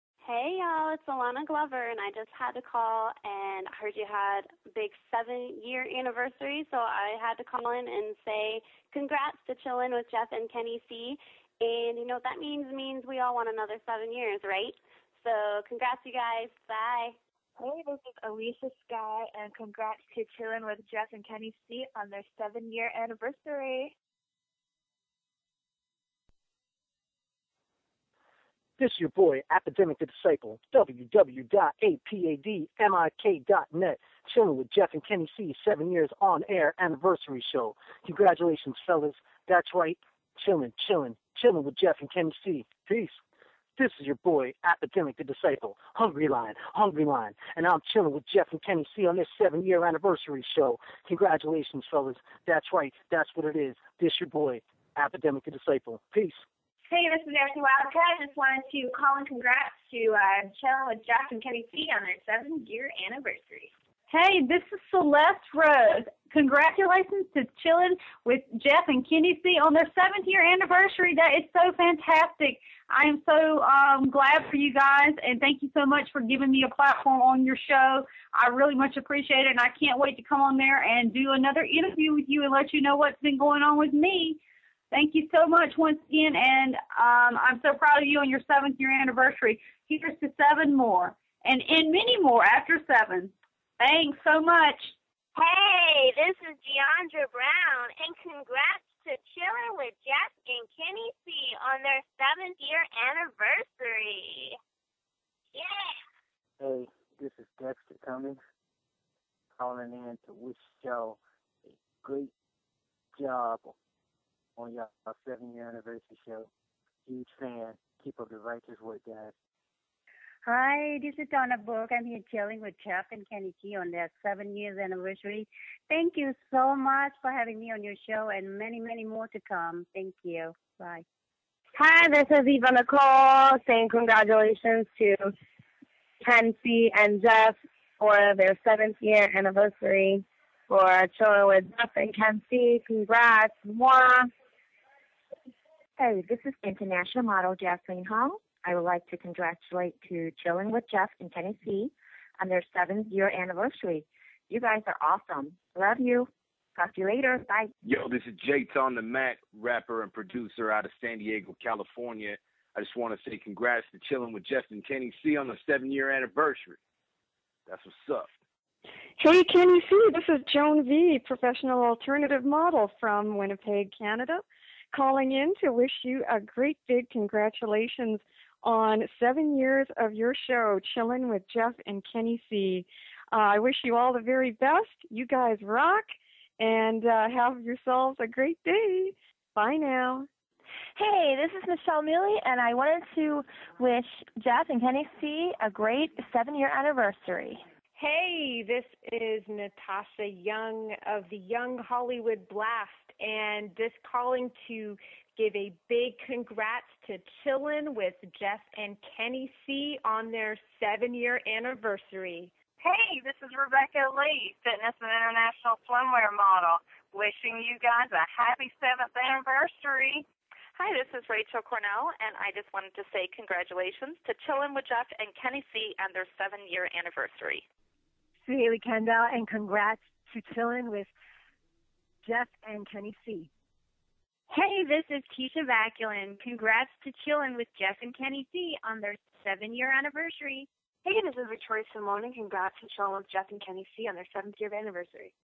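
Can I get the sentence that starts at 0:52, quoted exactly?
That's right, that's what it is.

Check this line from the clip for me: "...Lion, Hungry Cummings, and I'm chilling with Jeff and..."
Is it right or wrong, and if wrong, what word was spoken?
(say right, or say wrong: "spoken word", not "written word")
wrong: "Lion", not "Cummings".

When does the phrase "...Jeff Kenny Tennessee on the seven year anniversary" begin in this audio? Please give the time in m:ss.
2:44.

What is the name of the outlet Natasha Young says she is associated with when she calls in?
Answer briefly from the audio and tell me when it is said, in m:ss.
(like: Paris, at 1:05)
Young Hollywood Blast, at 3:21.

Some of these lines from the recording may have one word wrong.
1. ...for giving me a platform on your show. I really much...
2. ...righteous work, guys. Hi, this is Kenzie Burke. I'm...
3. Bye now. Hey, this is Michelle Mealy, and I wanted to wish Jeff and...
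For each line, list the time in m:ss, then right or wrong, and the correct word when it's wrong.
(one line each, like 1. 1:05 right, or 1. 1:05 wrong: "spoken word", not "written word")
1. 1:16 right
2. 1:58 wrong: "Donna", not "Kenzie"
3. 3:09 right.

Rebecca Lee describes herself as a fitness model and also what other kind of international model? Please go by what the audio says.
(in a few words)
swimwear.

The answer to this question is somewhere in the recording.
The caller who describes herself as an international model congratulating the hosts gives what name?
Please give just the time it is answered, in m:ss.
2:27.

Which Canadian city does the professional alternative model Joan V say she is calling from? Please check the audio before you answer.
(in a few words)
Winnipeg.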